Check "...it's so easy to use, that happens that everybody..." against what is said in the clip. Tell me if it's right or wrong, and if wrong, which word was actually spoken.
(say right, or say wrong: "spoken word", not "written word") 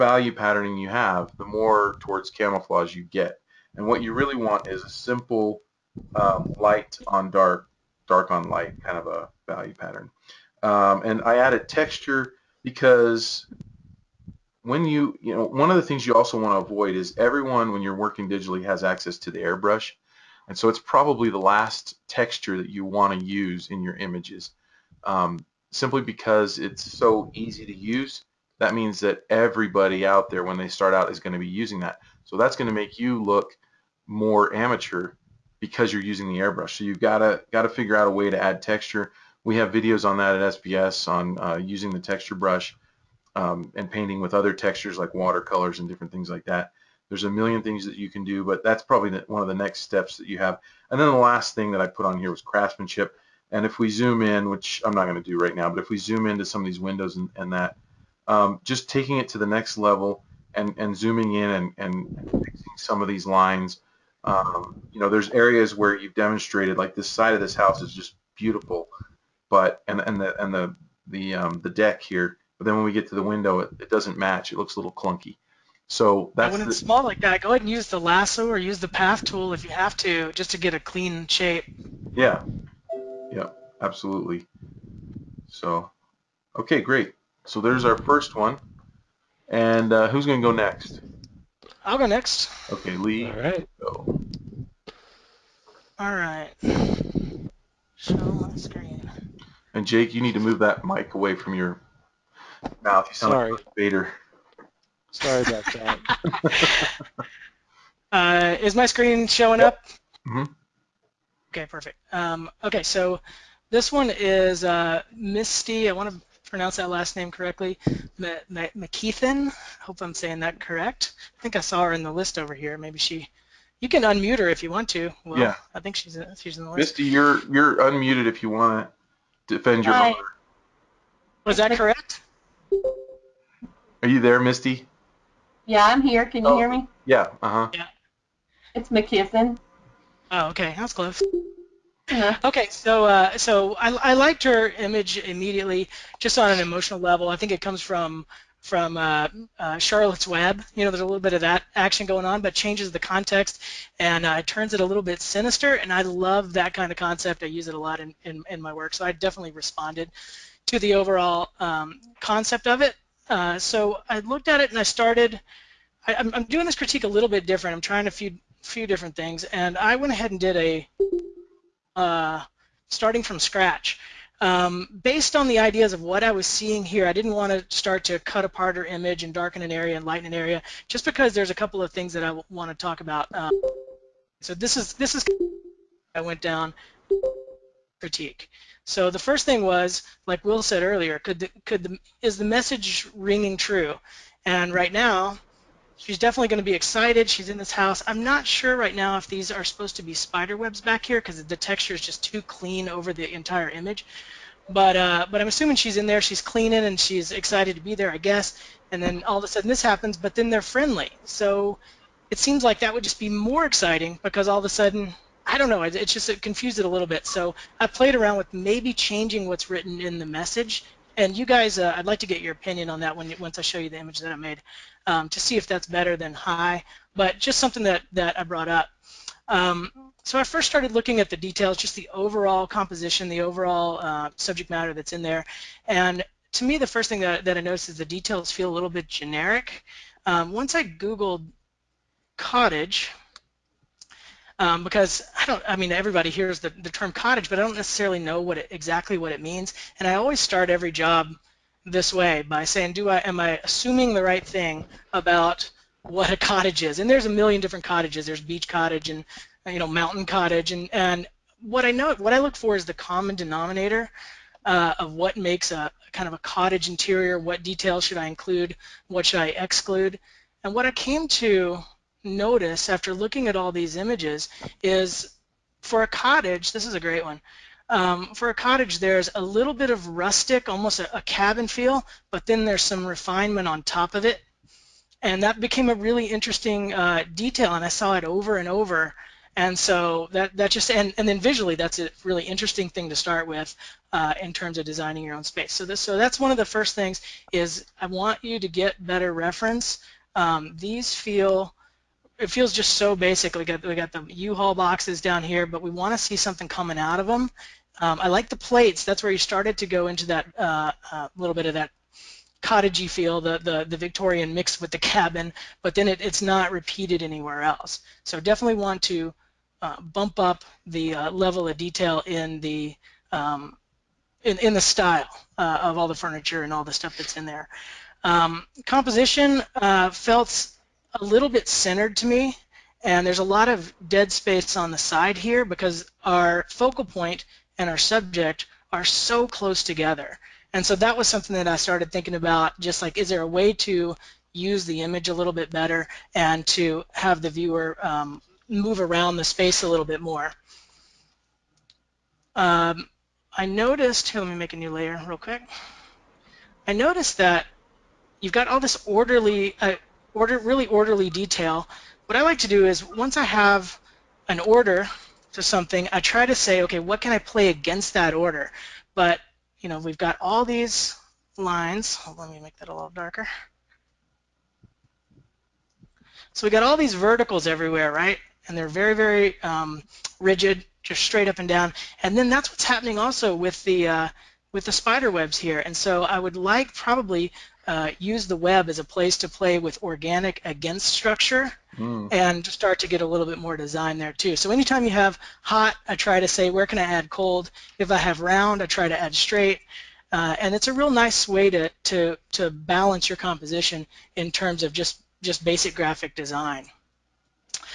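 wrong: "means", not "happens".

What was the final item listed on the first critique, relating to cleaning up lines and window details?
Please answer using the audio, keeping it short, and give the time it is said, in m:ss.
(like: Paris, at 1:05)
craftsmanship, at 0:52.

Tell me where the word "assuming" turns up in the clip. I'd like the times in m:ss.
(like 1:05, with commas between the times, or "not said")
3:25, 4:13.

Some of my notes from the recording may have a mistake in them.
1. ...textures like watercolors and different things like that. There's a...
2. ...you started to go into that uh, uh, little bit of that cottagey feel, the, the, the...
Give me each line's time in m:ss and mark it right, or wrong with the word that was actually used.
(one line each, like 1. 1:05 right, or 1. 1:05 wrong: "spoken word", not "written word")
1. 0:44 right
2. 5:09 right.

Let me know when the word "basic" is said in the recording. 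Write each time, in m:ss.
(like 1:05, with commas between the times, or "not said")
5:03, 6:45.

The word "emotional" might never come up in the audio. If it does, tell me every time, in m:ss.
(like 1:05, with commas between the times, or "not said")
2:26.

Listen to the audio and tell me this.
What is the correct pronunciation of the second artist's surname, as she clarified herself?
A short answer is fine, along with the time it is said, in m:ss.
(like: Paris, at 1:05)
McKisson, at 2:18.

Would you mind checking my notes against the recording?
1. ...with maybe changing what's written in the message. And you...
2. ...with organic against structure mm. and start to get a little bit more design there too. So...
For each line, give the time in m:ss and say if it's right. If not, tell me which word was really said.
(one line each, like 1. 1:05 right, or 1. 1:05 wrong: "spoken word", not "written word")
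1. 3:38 right
2. 6:29 right.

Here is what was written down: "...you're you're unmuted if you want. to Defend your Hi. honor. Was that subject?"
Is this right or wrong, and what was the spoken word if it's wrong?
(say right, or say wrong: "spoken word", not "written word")
wrong: "correct", not "subject".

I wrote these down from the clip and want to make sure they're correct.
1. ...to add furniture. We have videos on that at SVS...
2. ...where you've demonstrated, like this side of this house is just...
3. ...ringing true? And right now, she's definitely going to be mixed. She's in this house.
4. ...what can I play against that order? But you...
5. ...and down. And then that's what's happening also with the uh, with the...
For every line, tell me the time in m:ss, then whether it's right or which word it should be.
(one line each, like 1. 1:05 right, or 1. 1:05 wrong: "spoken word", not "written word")
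1. 0:38 wrong: "texture", not "furniture"
2. 1:05 right
3. 3:13 wrong: "excited", not "mixed"
4. 6:06 right
5. 6:21 right.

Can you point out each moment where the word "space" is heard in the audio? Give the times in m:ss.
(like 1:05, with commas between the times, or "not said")
4:55, 5:34, 5:49.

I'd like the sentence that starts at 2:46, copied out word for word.
I, am doing this critique a little bit different.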